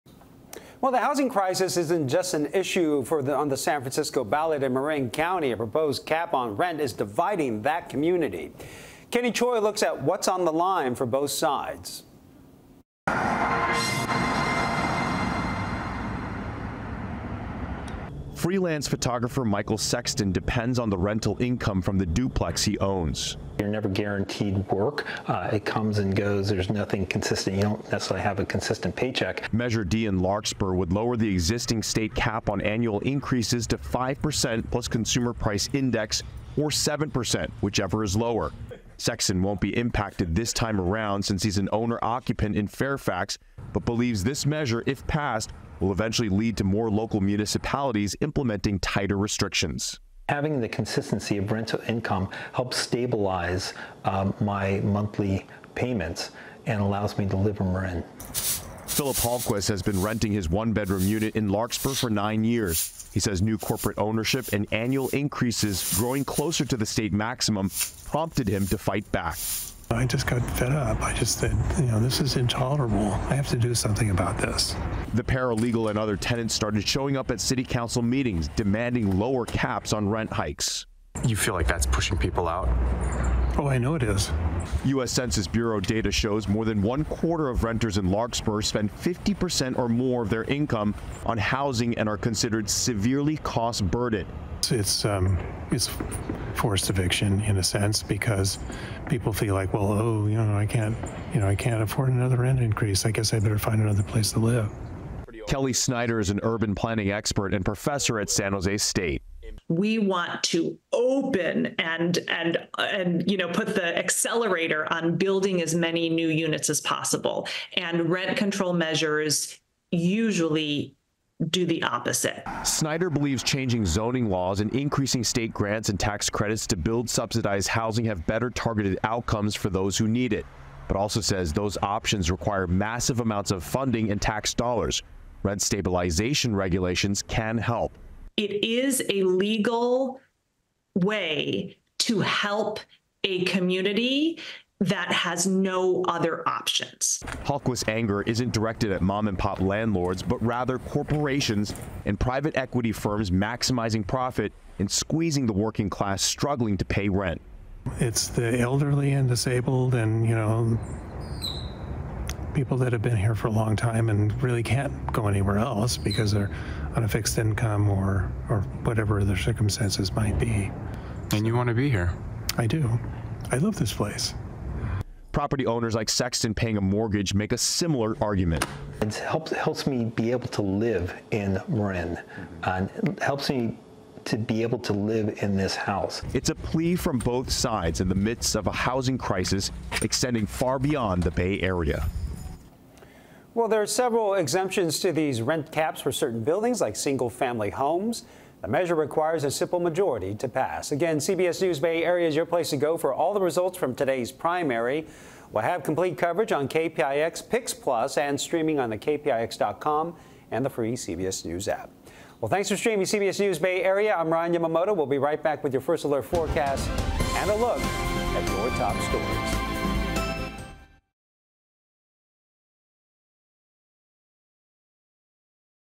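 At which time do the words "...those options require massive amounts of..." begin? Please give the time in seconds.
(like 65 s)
131 s.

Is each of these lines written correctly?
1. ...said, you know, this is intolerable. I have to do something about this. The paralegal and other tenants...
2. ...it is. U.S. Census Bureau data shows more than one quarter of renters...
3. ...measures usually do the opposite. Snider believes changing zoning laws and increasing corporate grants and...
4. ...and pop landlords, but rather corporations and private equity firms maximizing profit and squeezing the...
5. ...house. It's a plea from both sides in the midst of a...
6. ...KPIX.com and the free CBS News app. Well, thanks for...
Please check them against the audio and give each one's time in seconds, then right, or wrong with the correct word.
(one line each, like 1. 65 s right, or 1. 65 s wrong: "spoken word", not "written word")
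1. 71 s right
2. 83 s right
3. 118 s wrong: "state", not "corporate"
4. 149 s right
5. 185 s right
6. 208 s right.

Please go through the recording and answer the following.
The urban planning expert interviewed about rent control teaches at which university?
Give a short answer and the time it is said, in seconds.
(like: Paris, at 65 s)
San Jose State, at 108 s.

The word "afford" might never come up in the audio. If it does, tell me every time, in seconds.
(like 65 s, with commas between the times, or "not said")
101 s.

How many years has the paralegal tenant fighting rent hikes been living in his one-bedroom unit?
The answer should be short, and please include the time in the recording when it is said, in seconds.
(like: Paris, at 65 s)
9, at 62 s.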